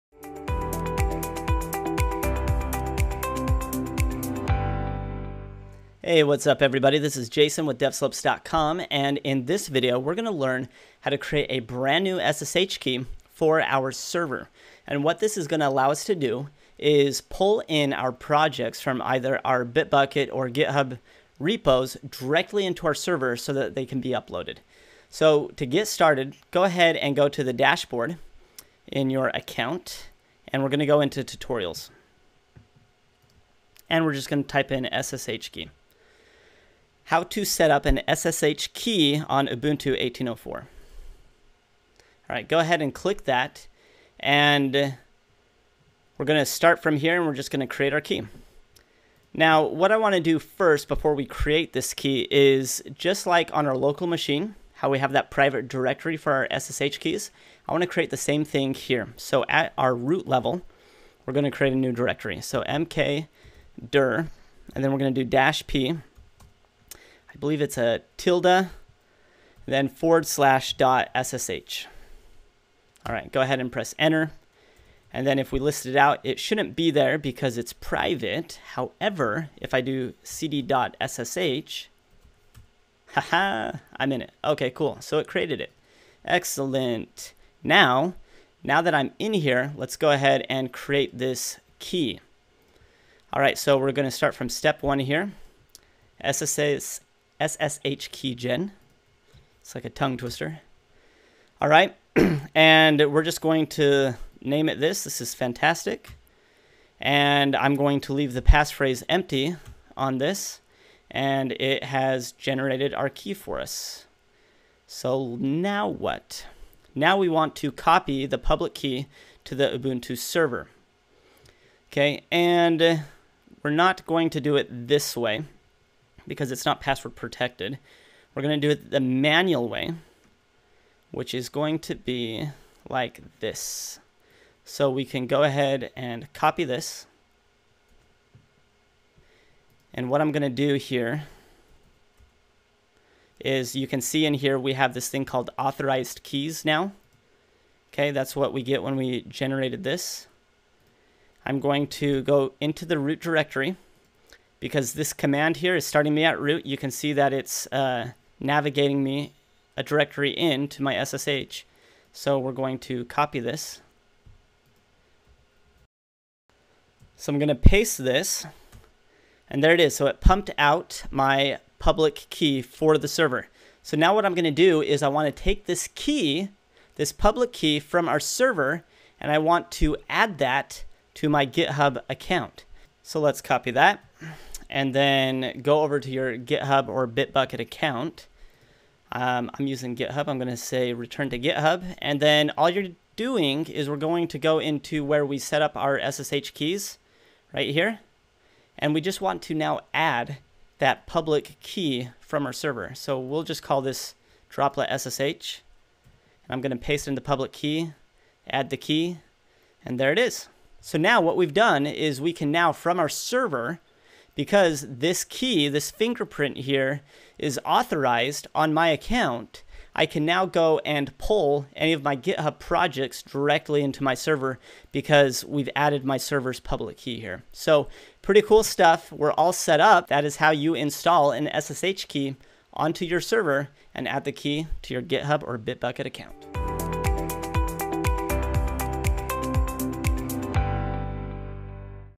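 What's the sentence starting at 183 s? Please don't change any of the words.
So let's copy that and then go over to your GitHub or Bitbucket account.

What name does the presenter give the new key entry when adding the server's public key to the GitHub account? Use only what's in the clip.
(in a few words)
droplet SSH.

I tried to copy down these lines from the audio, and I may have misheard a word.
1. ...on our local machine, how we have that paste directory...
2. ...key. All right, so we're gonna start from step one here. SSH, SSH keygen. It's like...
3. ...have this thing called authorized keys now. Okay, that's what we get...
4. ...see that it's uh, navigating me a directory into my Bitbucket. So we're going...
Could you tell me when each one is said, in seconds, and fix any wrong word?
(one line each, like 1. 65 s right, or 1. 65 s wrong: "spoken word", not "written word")
1. 53 s wrong: "private", not "paste"
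2. 91 s right
3. 144 s right
4. 156 s wrong: "SSH", not "Bitbucket".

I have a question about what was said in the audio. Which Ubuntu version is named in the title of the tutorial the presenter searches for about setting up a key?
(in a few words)
18.04.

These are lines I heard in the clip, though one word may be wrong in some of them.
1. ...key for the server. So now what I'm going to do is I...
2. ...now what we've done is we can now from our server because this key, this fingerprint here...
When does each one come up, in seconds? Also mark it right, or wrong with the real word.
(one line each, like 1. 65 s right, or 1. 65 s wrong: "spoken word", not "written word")
1. 172 s right
2. 210 s right.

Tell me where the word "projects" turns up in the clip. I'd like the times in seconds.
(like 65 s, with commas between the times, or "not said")
18 s, 222 s.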